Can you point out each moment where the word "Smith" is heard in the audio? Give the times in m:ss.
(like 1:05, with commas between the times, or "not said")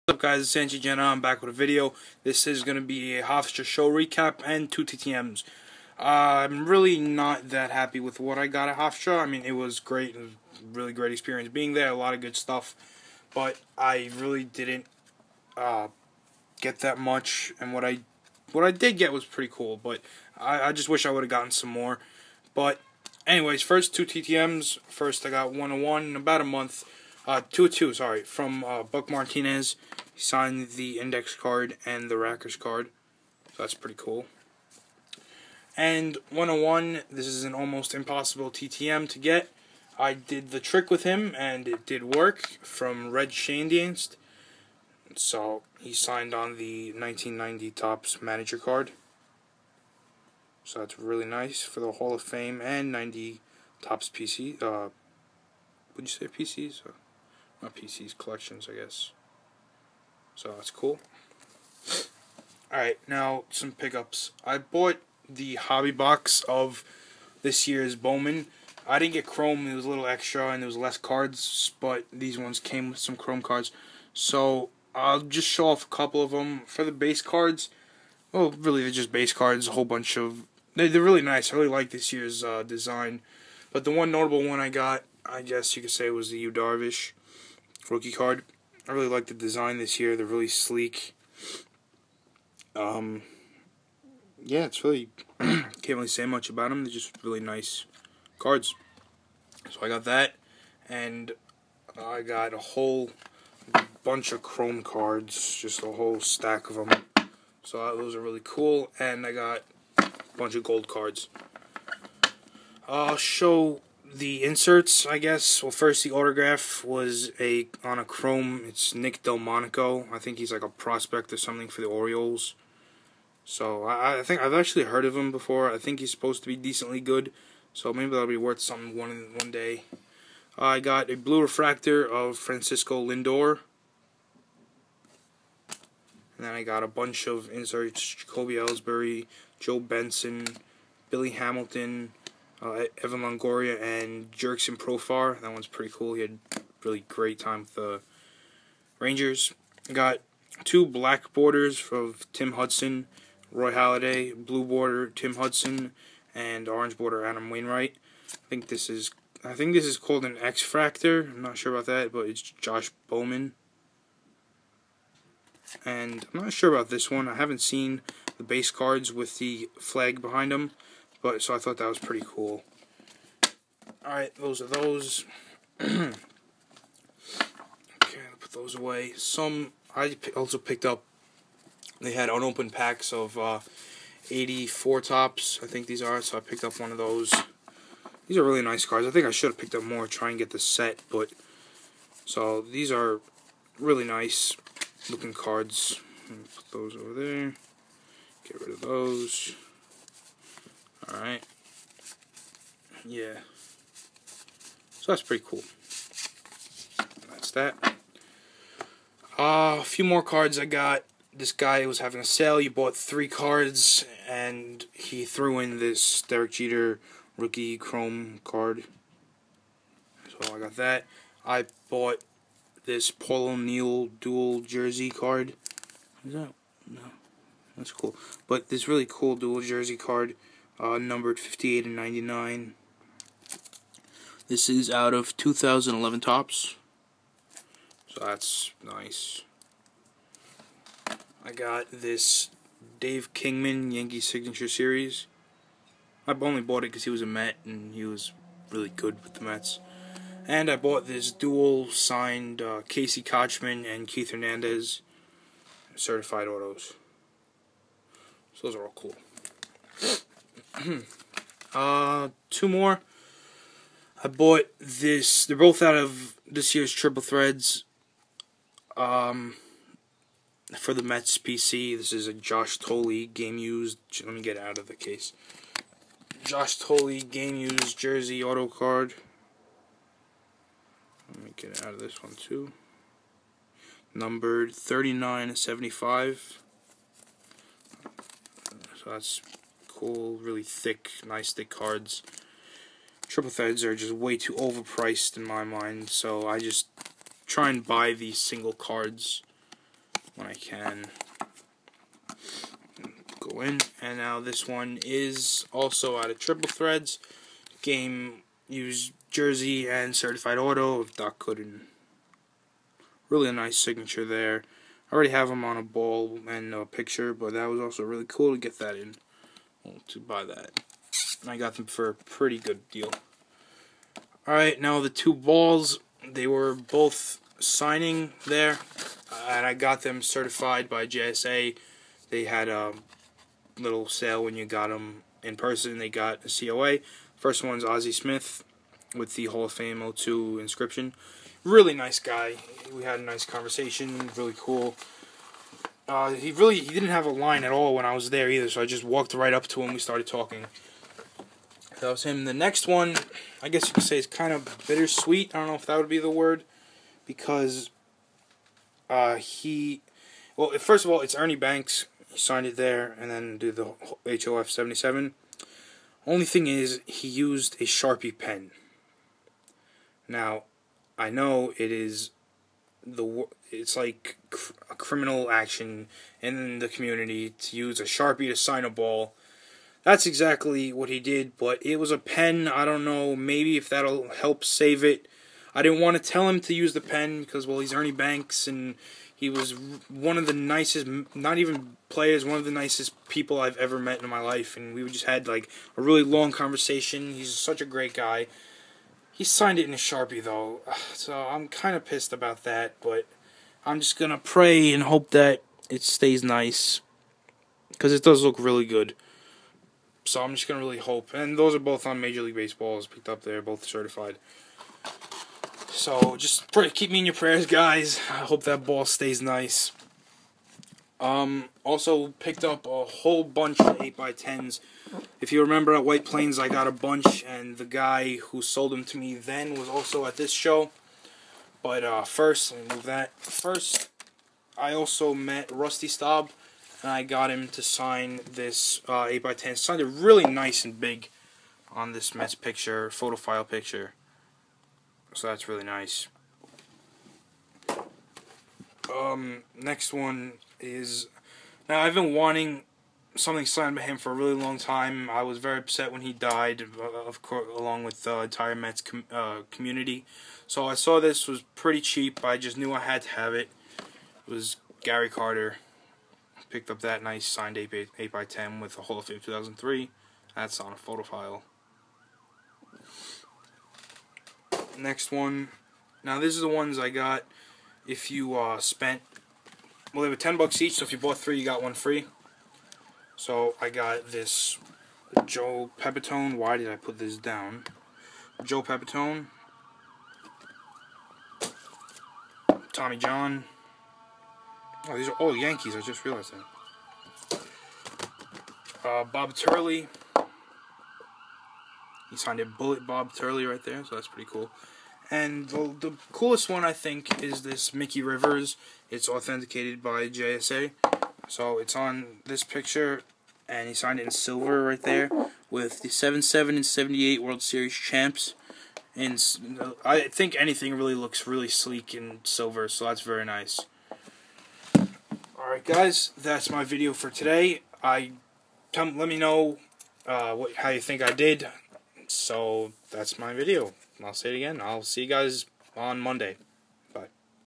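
5:38.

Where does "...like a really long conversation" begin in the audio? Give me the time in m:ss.
6:35.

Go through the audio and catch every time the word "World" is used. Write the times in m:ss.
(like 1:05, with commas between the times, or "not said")
8:37.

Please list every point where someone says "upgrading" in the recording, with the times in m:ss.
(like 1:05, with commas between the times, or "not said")
not said.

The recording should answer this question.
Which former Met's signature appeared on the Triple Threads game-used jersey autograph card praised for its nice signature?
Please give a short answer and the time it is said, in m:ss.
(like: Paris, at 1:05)
Doc Gooden, at 5:11.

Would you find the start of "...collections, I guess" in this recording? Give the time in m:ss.
0:58.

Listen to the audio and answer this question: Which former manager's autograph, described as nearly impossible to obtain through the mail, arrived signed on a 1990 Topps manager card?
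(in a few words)
Red Schoendienst.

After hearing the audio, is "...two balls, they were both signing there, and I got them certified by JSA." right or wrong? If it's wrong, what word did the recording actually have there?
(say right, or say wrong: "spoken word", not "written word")
right.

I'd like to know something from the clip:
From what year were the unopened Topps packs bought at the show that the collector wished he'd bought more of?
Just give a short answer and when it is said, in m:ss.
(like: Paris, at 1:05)
1984, at 3:04.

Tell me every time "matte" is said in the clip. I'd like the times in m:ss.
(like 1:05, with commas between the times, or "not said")
not said.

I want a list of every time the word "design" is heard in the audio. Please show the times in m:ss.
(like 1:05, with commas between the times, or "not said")
1:22, 1:29.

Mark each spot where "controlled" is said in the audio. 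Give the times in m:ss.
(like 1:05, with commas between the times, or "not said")
not said.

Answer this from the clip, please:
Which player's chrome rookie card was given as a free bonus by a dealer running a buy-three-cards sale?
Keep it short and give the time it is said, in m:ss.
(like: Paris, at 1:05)
Derek Jeter, at 3:36.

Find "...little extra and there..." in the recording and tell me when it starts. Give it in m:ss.
1:09.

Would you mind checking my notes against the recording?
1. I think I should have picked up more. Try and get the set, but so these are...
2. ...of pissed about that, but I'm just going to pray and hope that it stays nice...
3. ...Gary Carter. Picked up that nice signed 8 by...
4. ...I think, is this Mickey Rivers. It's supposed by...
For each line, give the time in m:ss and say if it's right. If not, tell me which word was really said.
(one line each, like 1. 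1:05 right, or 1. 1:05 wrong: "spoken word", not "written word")
1. 3:09 right
2. 6:41 right
3. 7:45 right
4. 8:26 wrong: "authenticated", not "supposed".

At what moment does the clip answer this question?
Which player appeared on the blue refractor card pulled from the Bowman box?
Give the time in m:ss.
2:12.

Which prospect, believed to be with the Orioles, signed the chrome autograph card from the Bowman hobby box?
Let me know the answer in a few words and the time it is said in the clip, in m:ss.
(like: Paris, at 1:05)
Nick Delmonico, at 1:58.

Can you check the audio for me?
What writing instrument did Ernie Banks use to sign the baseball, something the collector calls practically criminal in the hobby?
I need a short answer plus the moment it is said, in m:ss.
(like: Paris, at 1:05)
Sharpie pen, at 6:07.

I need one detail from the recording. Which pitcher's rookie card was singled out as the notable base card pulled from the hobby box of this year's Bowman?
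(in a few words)
Yu Darvish.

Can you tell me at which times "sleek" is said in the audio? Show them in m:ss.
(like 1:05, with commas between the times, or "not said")
1:30, 8:41.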